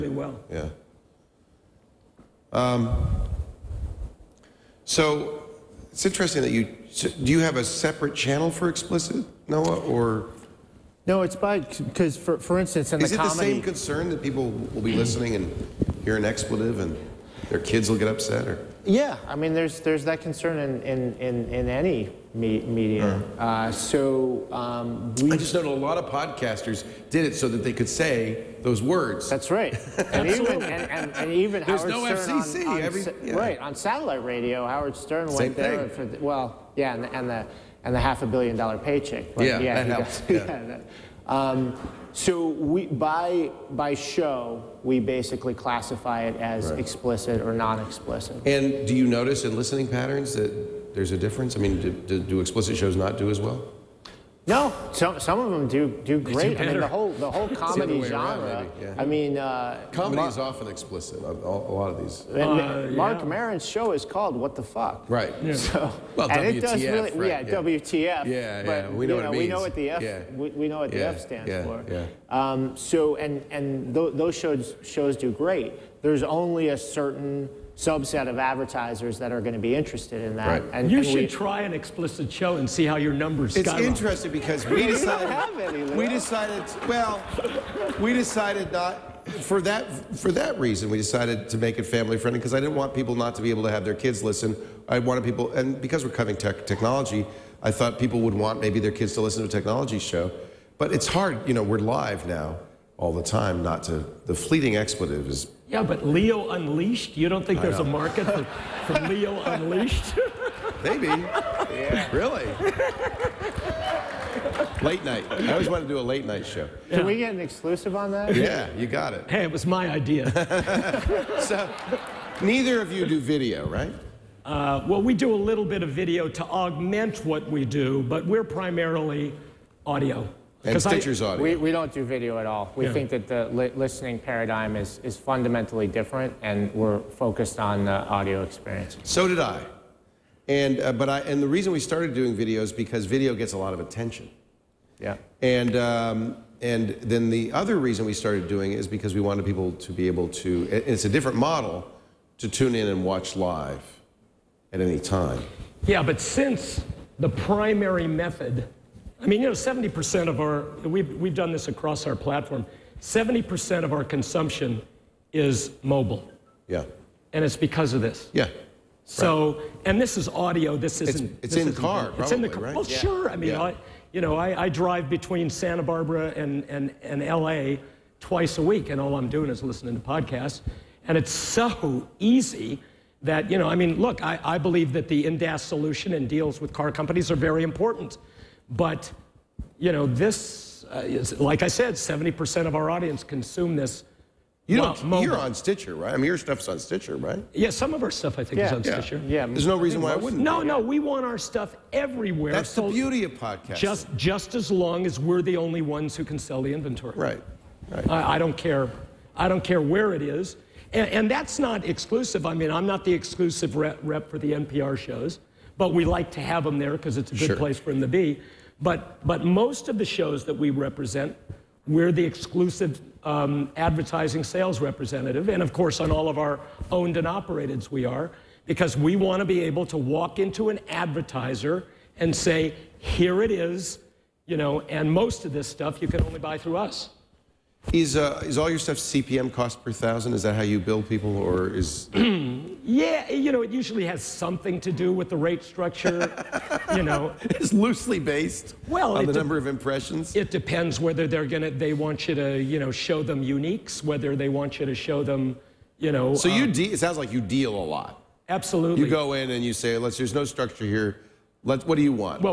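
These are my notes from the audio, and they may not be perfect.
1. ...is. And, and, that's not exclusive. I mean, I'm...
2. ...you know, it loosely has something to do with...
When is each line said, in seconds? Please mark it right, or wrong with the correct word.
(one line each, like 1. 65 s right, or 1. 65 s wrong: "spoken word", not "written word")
1. 210 s right
2. 243 s wrong: "usually", not "loosely".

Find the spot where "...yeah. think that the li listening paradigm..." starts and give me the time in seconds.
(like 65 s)
132 s.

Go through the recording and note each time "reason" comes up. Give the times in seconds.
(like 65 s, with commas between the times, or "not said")
90 s, 141 s, 147 s, 199 s.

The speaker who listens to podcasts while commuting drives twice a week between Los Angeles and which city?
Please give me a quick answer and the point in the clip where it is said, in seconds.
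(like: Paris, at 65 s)
Santa Barbara, at 175 s.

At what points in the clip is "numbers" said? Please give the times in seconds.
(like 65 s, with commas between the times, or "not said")
83 s, 249 s.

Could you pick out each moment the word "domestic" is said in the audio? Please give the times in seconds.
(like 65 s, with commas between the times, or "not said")
not said.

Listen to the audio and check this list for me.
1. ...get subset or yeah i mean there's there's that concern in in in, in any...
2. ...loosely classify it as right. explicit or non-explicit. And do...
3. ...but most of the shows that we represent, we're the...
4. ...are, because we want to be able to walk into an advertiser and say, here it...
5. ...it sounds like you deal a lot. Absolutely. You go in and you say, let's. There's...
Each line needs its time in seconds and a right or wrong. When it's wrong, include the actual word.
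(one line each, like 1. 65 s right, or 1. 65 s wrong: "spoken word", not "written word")
1. 17 s wrong: "upset", not "subset"
2. 44 s wrong: "basically", not "loosely"
3. 219 s right
4. 228 s right
5. 256 s right.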